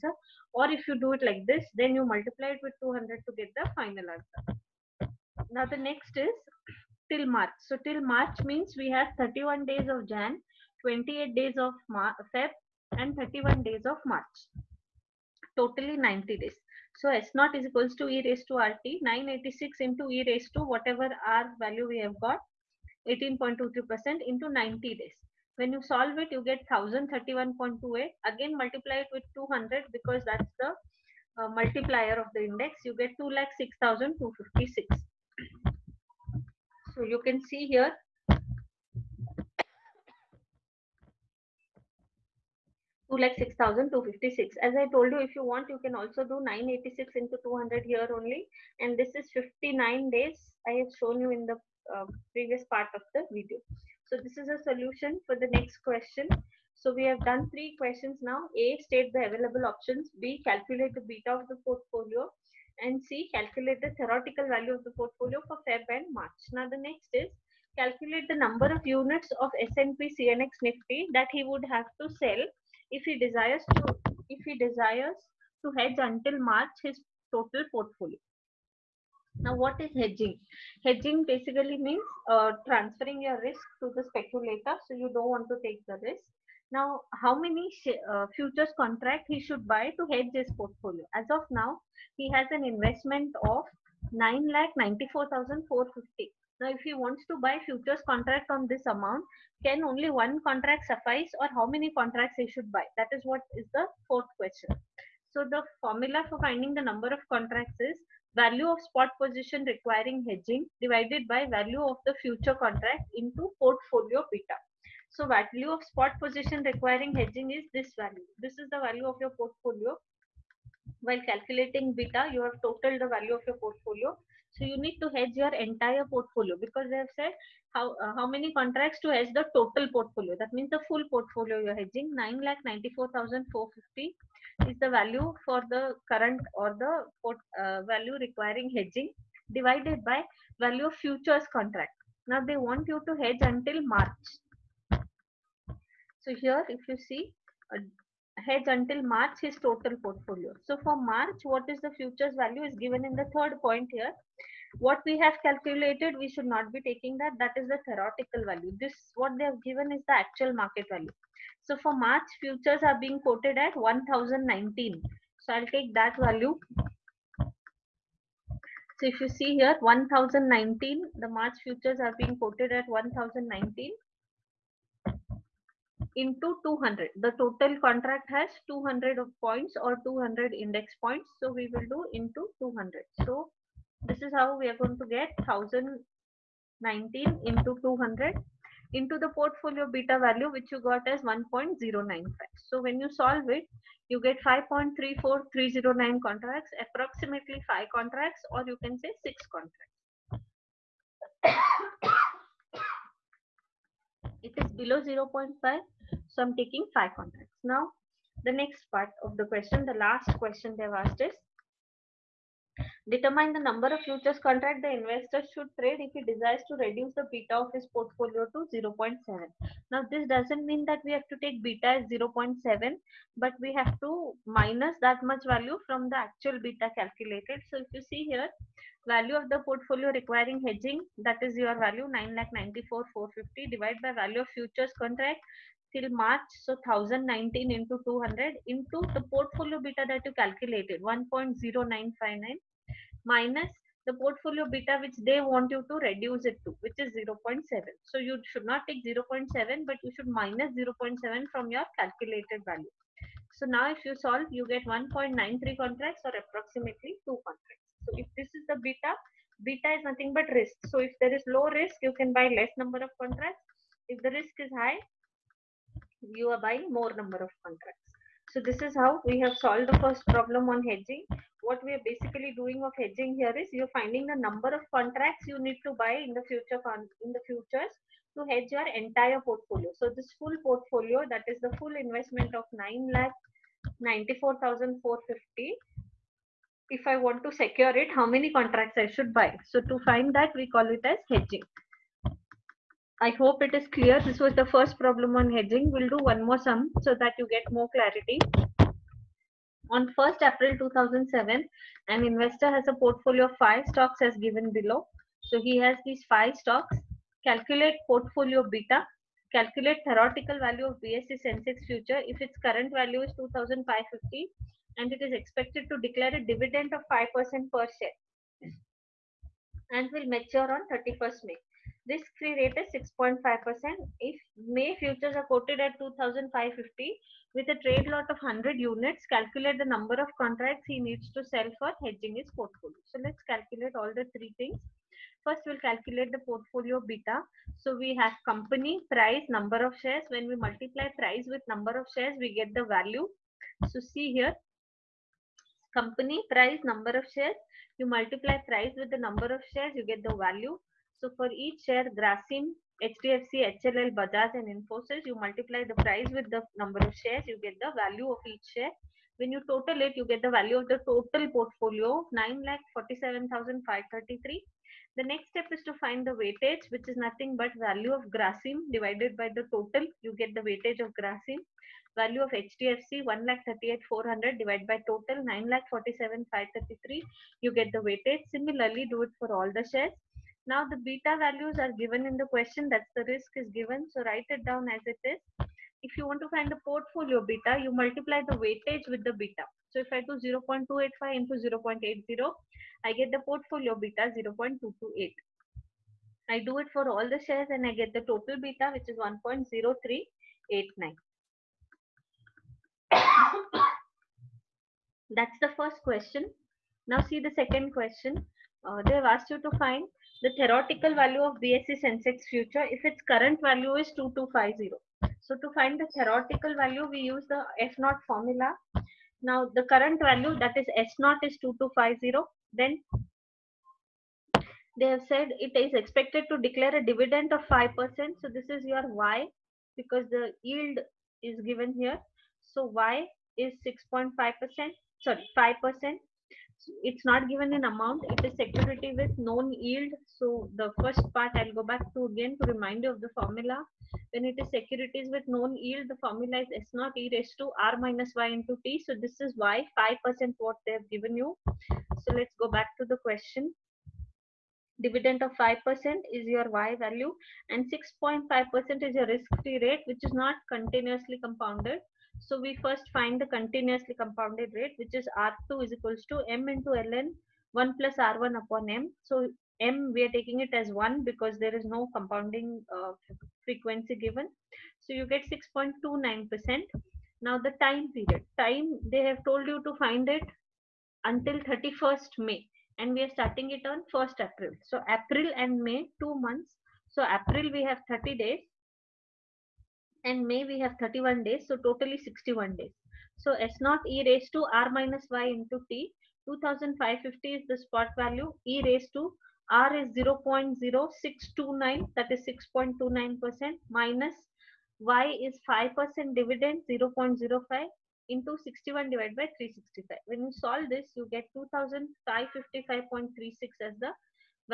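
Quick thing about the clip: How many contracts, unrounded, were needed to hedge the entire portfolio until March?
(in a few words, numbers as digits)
5.34309.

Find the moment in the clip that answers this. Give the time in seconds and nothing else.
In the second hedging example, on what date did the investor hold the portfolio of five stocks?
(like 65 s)
300 s.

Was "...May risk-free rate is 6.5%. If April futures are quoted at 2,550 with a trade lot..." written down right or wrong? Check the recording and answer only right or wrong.
wrong.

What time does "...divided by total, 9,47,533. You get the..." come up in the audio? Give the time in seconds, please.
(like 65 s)
374 s.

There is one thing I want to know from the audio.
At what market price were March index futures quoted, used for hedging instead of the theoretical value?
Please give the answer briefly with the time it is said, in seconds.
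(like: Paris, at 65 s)
1019, at 161 s.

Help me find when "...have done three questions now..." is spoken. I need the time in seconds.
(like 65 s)
57 s.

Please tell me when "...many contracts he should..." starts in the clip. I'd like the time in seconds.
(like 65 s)
101 s.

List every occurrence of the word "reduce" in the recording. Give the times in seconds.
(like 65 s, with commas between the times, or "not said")
216 s, 246 s.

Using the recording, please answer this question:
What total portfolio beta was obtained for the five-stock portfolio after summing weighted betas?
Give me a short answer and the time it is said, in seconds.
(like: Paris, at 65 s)
1.0389, at 399 s.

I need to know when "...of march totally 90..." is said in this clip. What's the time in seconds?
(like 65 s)
13 s.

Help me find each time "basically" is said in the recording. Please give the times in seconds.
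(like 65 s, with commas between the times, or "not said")
81 s, 272 s.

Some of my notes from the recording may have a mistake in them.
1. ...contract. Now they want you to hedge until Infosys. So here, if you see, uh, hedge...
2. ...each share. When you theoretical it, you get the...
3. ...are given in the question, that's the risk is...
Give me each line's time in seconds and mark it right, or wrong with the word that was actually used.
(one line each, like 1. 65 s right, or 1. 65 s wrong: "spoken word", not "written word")
1. 141 s wrong: "March", not "Infosys"
2. 358 s wrong: "total", not "theoretical"
3. 381 s right.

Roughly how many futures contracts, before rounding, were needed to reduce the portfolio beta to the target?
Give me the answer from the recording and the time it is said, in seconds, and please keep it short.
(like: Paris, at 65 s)
1.93, at 254 s.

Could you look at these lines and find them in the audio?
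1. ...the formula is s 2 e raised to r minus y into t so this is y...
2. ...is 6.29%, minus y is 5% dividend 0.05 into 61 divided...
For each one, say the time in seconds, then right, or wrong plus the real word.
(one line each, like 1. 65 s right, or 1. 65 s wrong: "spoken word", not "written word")
1. 446 s wrong: "0", not "2"
2. 502 s right.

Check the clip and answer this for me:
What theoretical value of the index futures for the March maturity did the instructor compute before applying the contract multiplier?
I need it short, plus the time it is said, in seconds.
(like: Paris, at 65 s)
1031.28, at 26 s.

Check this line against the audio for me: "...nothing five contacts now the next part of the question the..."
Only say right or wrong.
wrong.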